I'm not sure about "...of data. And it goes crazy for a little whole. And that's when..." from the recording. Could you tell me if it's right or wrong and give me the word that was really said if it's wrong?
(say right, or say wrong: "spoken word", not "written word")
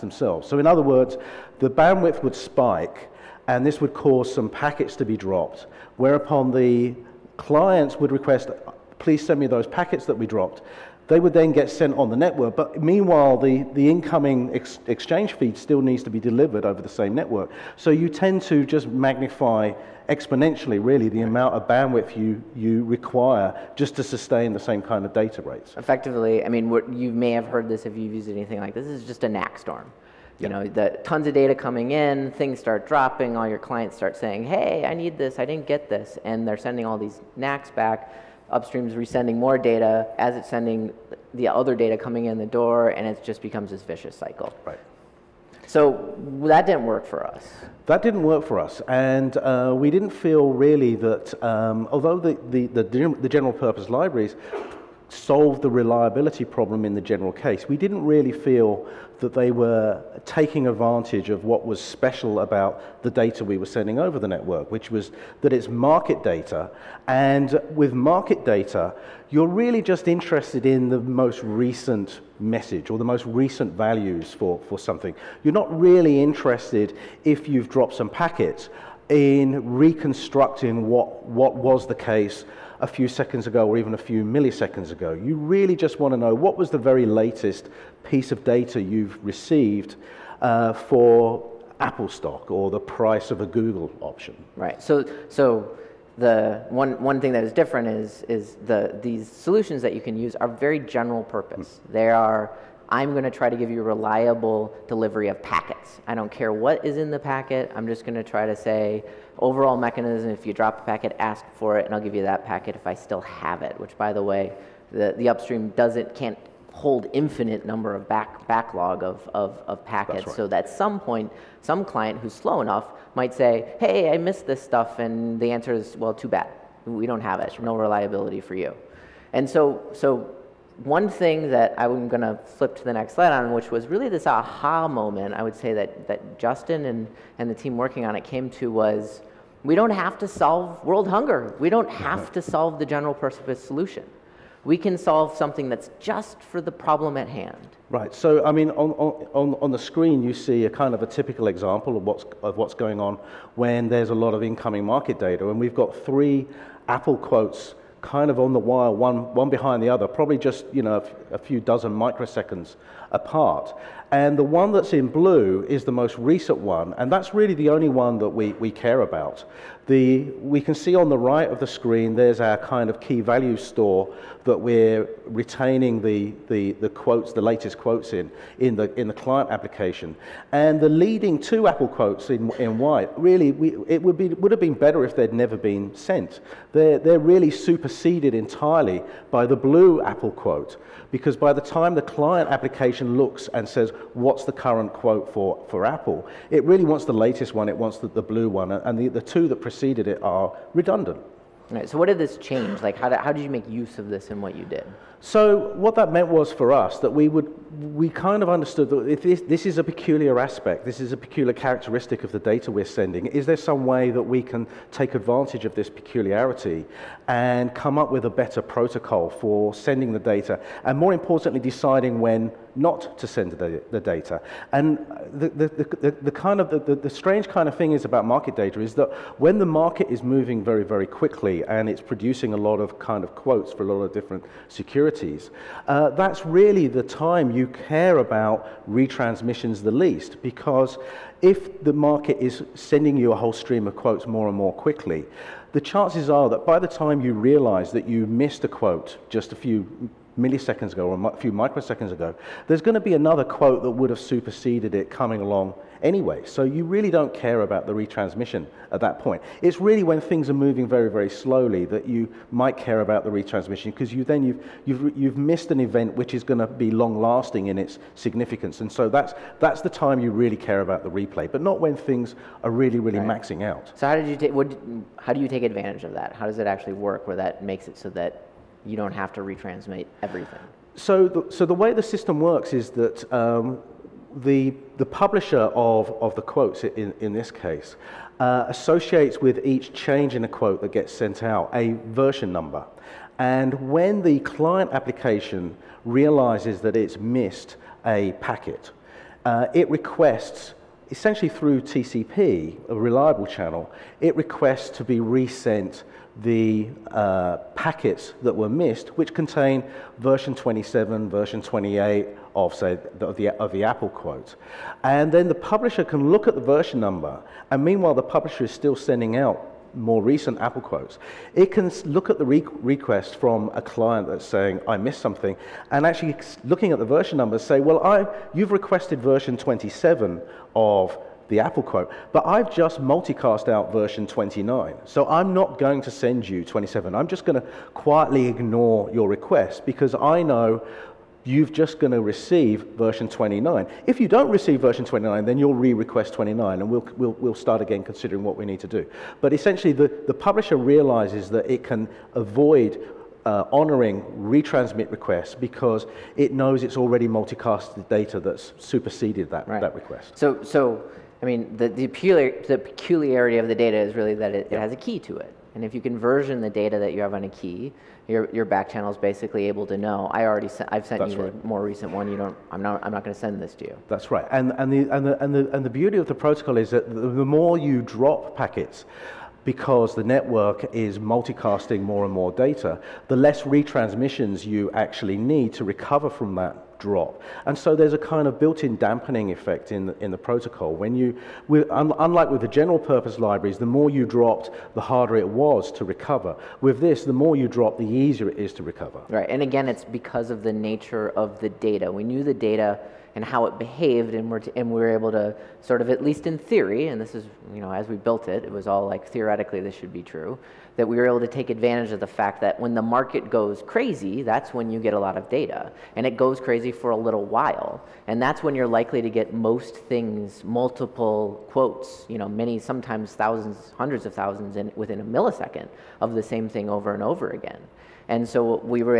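wrong: "while", not "whole".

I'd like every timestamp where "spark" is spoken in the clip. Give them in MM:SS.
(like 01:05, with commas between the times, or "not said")
not said.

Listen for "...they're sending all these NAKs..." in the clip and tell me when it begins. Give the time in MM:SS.
00:36.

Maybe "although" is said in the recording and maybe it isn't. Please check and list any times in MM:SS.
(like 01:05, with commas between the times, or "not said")
00:51.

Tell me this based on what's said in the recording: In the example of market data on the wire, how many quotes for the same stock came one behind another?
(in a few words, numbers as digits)
3.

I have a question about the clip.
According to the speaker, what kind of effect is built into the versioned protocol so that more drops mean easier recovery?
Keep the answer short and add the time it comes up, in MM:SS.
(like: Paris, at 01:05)
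Dampening effect, at 06:28.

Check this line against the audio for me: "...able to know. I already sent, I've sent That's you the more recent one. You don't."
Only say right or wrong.
right.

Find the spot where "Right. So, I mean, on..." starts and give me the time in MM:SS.
02:27.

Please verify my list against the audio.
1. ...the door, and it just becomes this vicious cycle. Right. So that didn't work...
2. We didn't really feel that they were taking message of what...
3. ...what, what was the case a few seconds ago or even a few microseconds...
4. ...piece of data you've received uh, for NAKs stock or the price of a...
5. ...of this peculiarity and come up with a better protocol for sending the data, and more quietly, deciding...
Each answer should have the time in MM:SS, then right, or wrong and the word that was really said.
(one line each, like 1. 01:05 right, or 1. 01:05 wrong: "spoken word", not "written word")
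1. 00:42 right
2. 00:57 wrong: "advantage", not "message"
3. 01:20 wrong: "milliseconds", not "microseconds"
4. 01:28 wrong: "Apple", not "NAKs"
5. 03:35 wrong: "importantly", not "quietly".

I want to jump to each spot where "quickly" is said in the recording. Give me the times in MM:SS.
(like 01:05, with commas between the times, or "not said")
03:51, 04:04.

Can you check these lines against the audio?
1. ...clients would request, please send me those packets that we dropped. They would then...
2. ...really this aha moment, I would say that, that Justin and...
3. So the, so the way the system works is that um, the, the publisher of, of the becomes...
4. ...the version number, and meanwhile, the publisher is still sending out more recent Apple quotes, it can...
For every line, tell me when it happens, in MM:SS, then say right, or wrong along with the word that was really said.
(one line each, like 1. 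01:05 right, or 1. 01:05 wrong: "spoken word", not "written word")
1. 00:07 right
2. 02:13 right
3. 04:40 wrong: "quotes", not "becomes"
4. 05:16 right.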